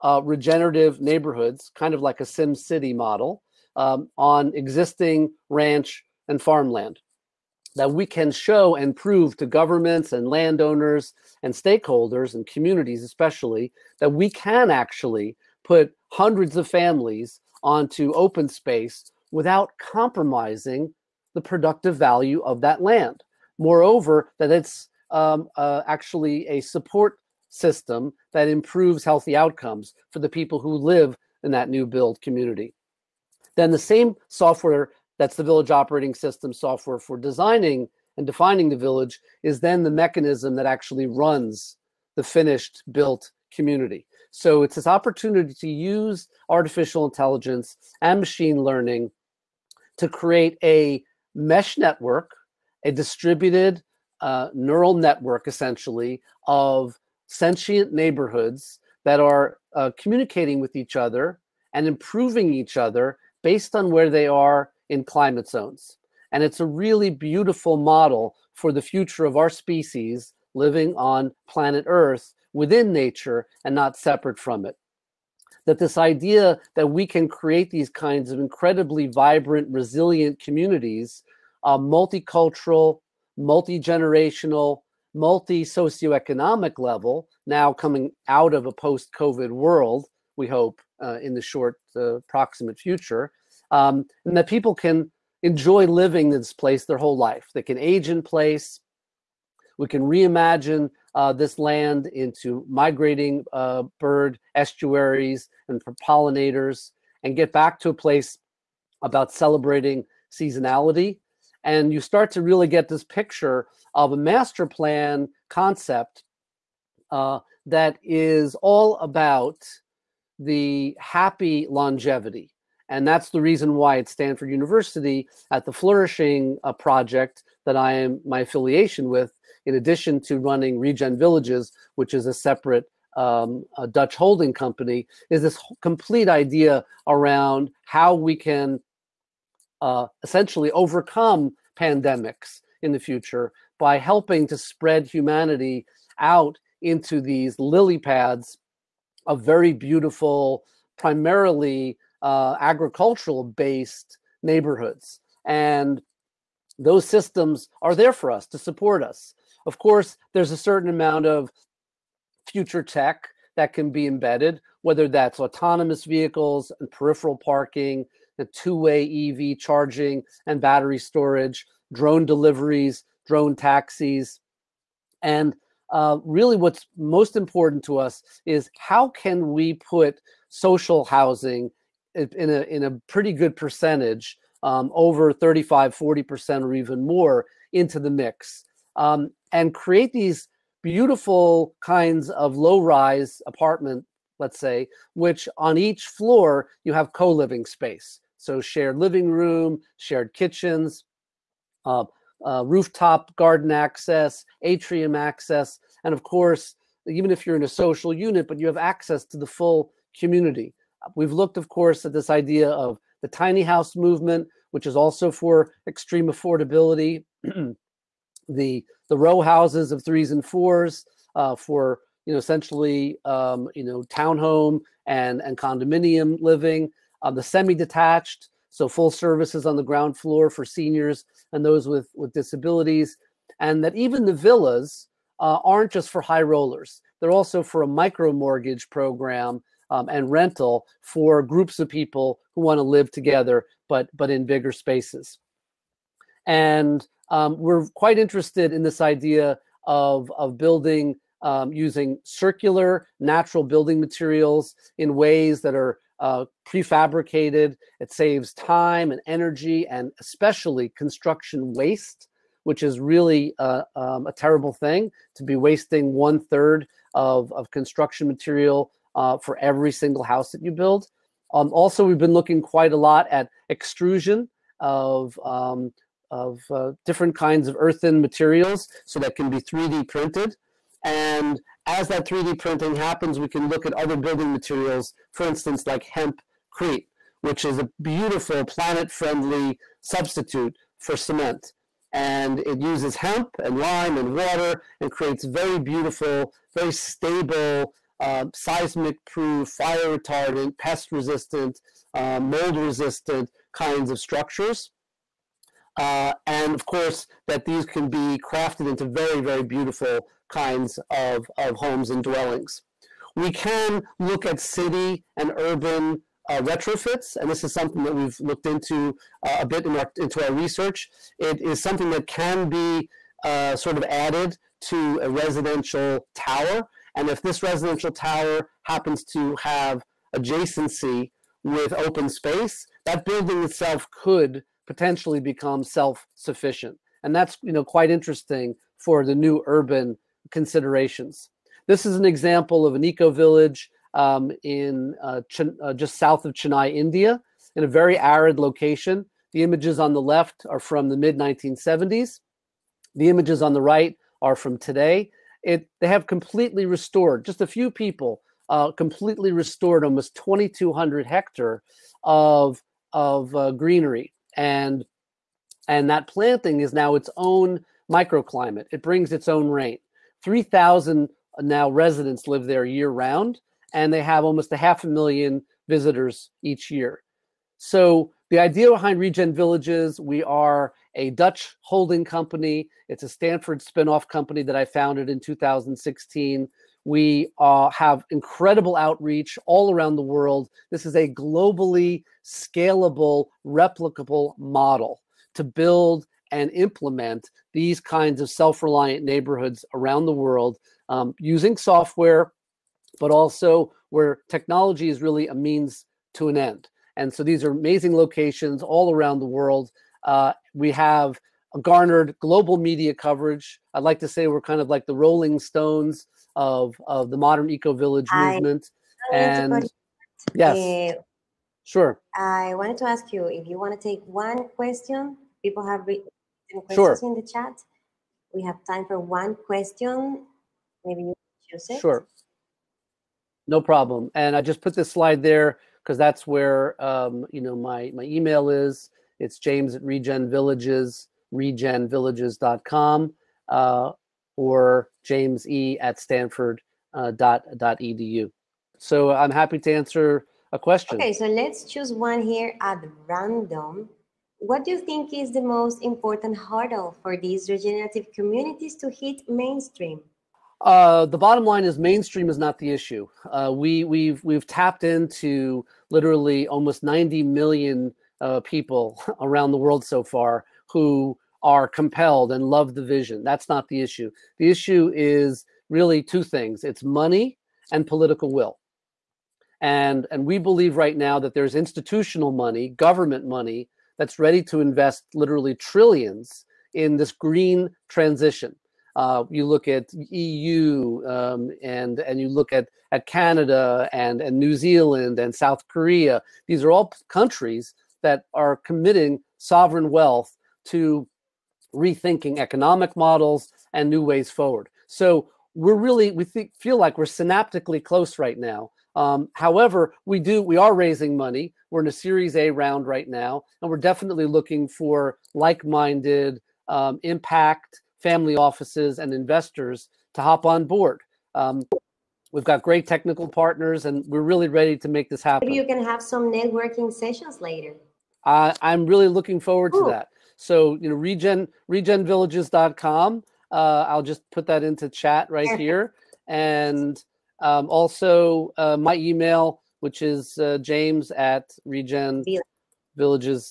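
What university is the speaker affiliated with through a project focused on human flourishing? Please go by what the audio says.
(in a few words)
Stanford University.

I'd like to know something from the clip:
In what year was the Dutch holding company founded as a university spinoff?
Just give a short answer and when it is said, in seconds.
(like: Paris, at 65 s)
2016, at 385 s.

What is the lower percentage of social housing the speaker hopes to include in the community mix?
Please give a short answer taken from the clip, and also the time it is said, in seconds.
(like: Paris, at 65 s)
35%, at 185 s.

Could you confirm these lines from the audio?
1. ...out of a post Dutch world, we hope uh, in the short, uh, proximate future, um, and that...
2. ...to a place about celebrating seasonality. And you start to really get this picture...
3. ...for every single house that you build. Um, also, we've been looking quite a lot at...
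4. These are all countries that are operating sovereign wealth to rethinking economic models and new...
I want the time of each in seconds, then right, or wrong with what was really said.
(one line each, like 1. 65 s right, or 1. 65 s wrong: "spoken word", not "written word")
1. 88 s wrong: "COVID", not "Dutch"
2. 107 s right
3. 269 s right
4. 496 s wrong: "committing", not "operating".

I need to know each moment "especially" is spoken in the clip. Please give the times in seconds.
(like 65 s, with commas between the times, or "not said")
13 s, 260 s.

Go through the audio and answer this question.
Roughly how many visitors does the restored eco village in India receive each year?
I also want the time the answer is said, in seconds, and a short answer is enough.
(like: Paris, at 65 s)
Half a million, at 374 s.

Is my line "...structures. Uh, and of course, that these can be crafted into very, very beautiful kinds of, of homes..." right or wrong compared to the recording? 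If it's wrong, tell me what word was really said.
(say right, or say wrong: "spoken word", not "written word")
right.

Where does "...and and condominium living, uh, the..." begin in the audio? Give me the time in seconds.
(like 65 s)
225 s.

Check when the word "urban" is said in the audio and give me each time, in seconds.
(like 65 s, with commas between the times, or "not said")
315 s, 339 s.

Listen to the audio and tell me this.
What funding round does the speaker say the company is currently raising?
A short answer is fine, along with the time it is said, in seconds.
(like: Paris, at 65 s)
Series A, at 512 s.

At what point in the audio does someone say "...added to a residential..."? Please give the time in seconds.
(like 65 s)
324 s.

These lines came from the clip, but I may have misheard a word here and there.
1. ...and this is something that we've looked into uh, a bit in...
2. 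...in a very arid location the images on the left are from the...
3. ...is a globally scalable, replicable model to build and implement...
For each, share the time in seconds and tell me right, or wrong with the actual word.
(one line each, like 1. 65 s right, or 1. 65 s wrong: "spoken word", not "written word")
1. 317 s right
2. 347 s right
3. 391 s right.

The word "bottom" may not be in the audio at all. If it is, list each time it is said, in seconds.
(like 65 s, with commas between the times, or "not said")
461 s.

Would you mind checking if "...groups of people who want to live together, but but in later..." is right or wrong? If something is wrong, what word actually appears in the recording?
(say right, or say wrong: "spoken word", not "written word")
wrong: "bigger", not "later".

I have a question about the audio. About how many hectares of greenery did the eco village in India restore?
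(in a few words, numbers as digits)
2200.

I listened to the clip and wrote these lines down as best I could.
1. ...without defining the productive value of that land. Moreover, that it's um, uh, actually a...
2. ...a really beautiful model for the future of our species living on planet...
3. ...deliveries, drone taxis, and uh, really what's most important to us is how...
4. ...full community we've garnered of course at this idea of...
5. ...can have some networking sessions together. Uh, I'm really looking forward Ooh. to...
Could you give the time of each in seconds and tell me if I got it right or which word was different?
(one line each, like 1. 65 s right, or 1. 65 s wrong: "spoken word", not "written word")
1. 19 s wrong: "compromising", not "defining"
2. 66 s right
3. 172 s right
4. 209 s wrong: "looked", not "garnered"
5. 525 s wrong: "later", not "together".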